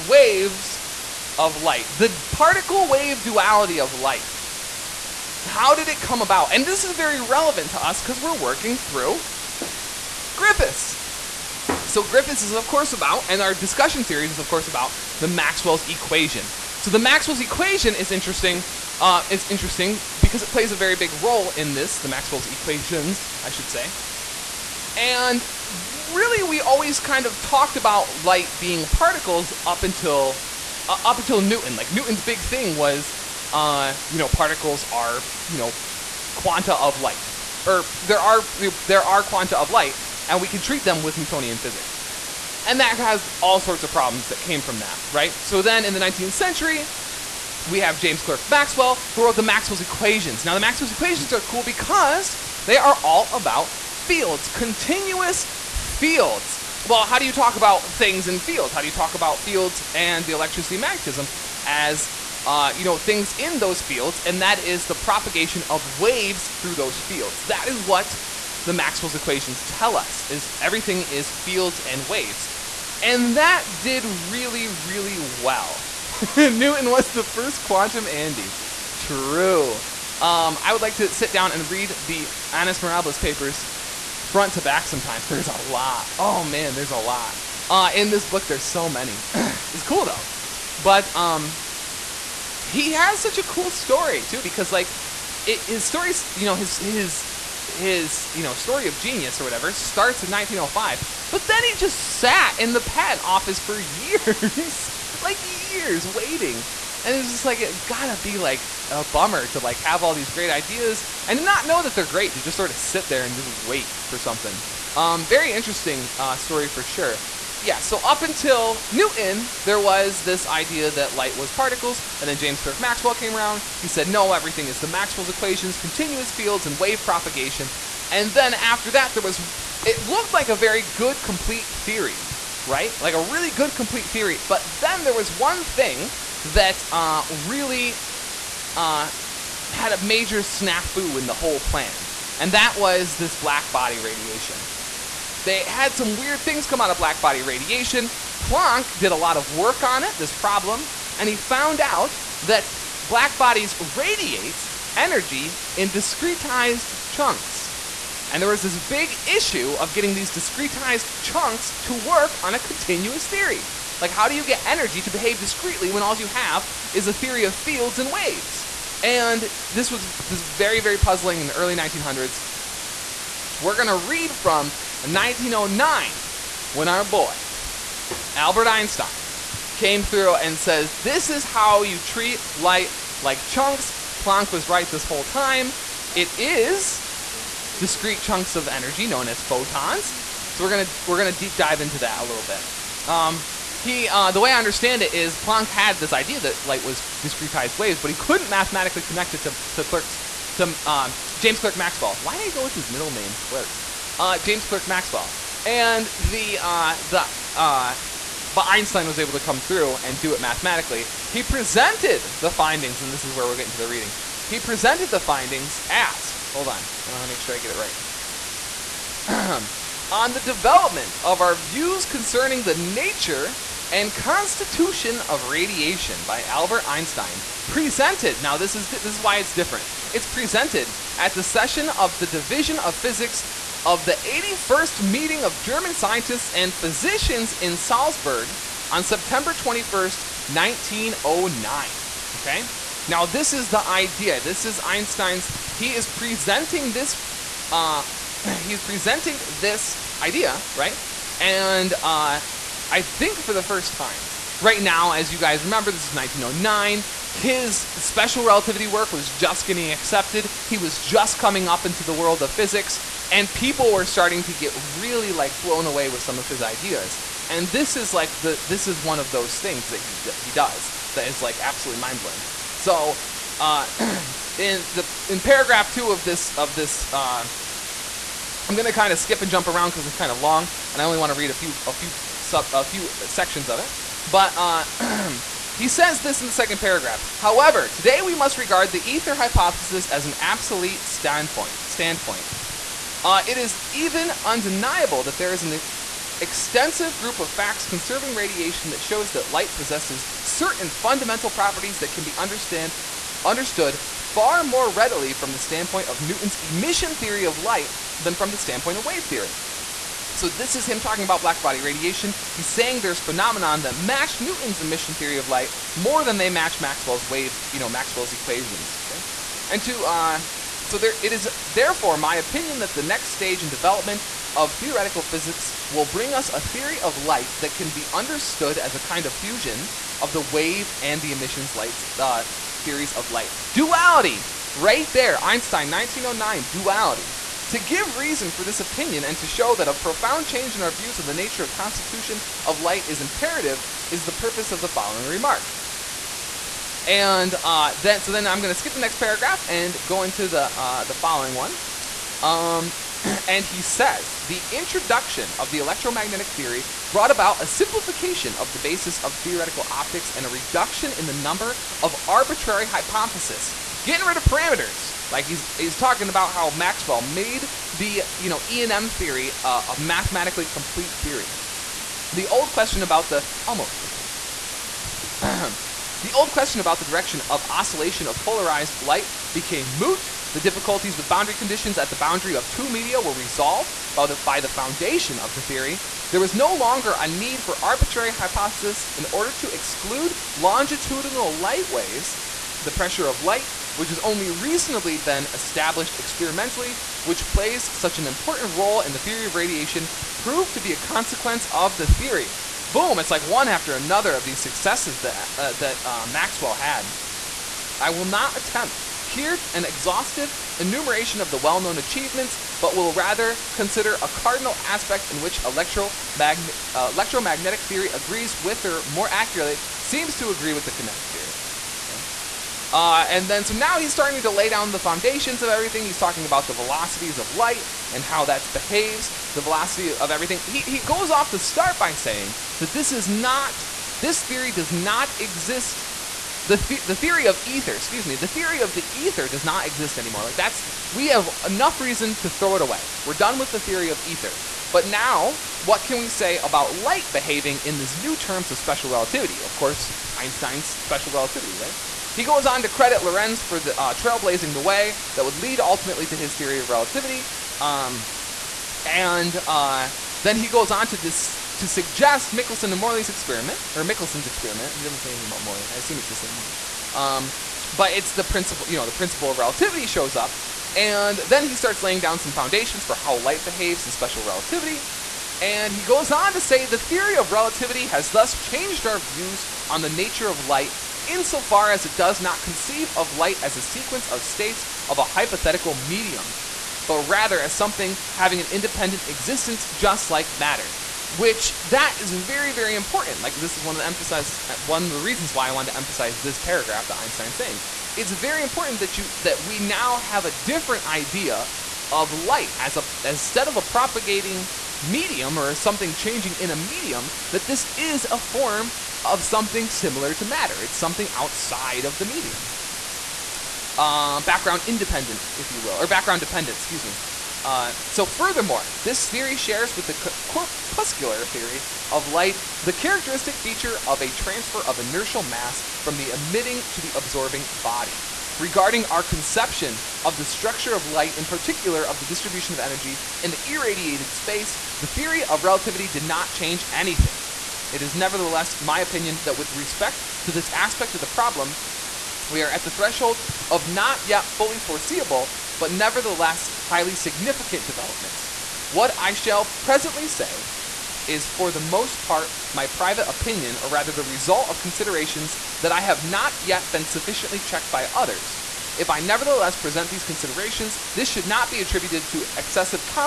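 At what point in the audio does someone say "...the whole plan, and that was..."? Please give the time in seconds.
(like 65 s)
141 s.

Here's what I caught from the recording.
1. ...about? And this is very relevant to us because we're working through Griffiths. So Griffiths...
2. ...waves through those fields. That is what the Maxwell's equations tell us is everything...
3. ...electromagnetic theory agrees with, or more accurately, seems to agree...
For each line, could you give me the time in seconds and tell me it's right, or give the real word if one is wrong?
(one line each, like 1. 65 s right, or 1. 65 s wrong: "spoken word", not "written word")
1. 6 s right
2. 65 s right
3. 417 s right.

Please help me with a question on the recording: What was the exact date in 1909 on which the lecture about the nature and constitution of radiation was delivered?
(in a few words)
September 21st, 1909.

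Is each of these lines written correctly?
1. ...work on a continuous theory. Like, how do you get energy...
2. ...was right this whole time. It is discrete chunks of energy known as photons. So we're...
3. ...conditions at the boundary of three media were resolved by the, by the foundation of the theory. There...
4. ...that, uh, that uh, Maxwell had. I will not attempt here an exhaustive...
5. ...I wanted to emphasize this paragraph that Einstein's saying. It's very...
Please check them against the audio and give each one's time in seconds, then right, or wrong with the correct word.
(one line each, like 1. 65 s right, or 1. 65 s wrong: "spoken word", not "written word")
1. 161 s right
2. 184 s right
3. 381 s wrong: "two", not "three"
4. 405 s right
5. 495 s right.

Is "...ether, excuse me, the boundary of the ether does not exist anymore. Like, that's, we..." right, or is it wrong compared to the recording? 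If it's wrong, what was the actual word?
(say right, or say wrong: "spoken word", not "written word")
wrong: "theory", not "boundary".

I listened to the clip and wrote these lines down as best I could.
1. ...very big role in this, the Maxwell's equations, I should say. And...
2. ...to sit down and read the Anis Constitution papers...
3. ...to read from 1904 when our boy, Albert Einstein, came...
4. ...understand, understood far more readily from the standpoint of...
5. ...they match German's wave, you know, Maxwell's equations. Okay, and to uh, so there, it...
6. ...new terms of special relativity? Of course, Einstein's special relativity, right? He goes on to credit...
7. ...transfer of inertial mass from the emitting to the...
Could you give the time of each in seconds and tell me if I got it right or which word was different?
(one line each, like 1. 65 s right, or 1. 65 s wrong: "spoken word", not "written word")
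1. 20 s right
2. 80 s wrong: "Mirabilis", not "Constitution"
3. 173 s wrong: "1909", not "1904"
4. 302 s right
5. 316 s wrong: "Maxwell", not "German"
6. 448 s right
7. 524 s right.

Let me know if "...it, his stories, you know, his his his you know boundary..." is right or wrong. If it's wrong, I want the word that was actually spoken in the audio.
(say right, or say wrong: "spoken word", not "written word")
wrong: "story", not "boundary".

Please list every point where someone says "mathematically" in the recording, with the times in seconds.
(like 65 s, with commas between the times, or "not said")
198 s, 210 s, 370 s.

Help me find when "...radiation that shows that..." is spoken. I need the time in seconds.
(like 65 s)
298 s.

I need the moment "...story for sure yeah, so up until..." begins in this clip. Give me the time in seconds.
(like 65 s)
116 s.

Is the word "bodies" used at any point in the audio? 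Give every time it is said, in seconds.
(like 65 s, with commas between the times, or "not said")
153 s.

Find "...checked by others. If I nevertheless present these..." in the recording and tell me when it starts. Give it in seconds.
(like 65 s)
557 s.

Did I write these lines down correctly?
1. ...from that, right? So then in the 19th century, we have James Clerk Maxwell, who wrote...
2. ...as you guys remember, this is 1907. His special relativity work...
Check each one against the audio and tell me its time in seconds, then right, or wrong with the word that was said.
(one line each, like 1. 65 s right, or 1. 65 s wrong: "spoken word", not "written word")
1. 44 s right
2. 255 s wrong: "1909", not "1907".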